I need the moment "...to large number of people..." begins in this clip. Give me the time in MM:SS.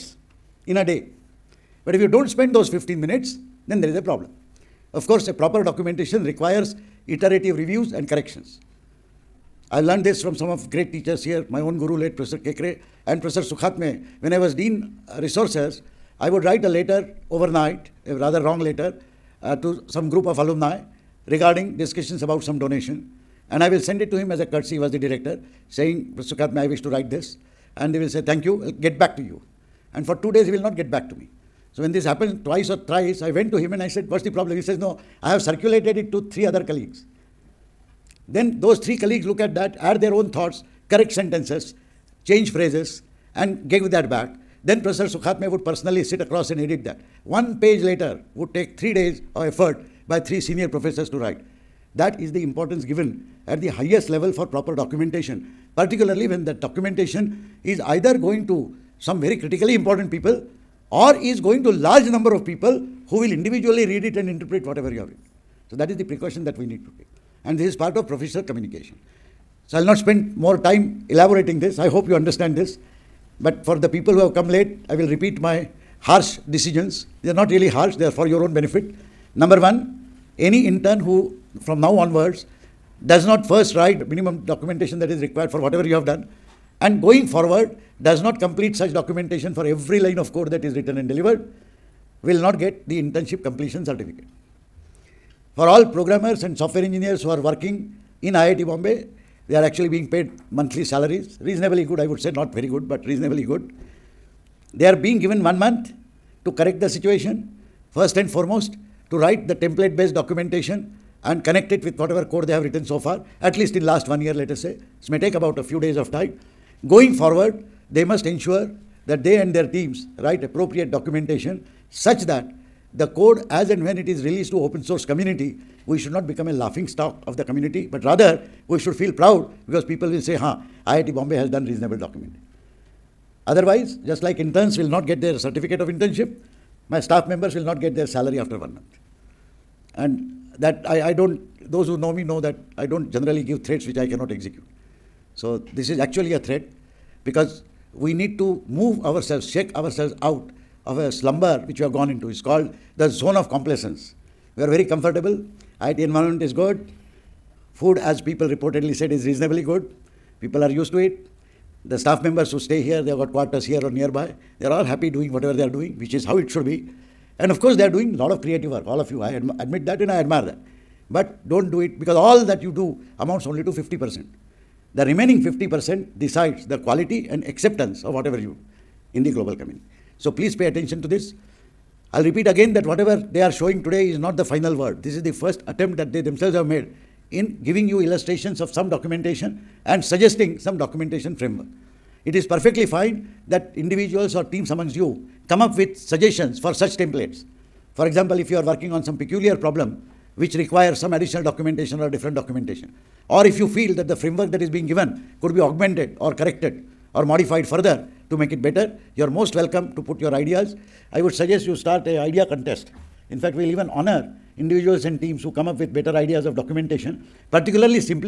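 01:01.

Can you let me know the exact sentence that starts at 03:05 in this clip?
This is the first attempt that they themselves have made in giving you illustrations of some documentation and suggesting some documentation framework.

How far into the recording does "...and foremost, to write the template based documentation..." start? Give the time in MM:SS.
01:48.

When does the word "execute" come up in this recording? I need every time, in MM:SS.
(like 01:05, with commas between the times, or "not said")
02:24.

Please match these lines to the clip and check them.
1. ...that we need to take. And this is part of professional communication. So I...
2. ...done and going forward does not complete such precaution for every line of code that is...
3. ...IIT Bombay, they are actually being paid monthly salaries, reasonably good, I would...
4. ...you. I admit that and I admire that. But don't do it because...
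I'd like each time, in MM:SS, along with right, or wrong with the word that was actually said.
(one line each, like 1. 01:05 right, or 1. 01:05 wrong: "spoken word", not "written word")
1. 01:06 right
2. 01:26 wrong: "documentation", not "precaution"
3. 01:38 right
4. 02:49 right.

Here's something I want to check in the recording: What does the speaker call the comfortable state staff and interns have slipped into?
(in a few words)
Zone of complacence.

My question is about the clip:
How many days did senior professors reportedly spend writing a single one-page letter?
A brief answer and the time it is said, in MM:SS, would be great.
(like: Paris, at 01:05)
3 days, at 00:48.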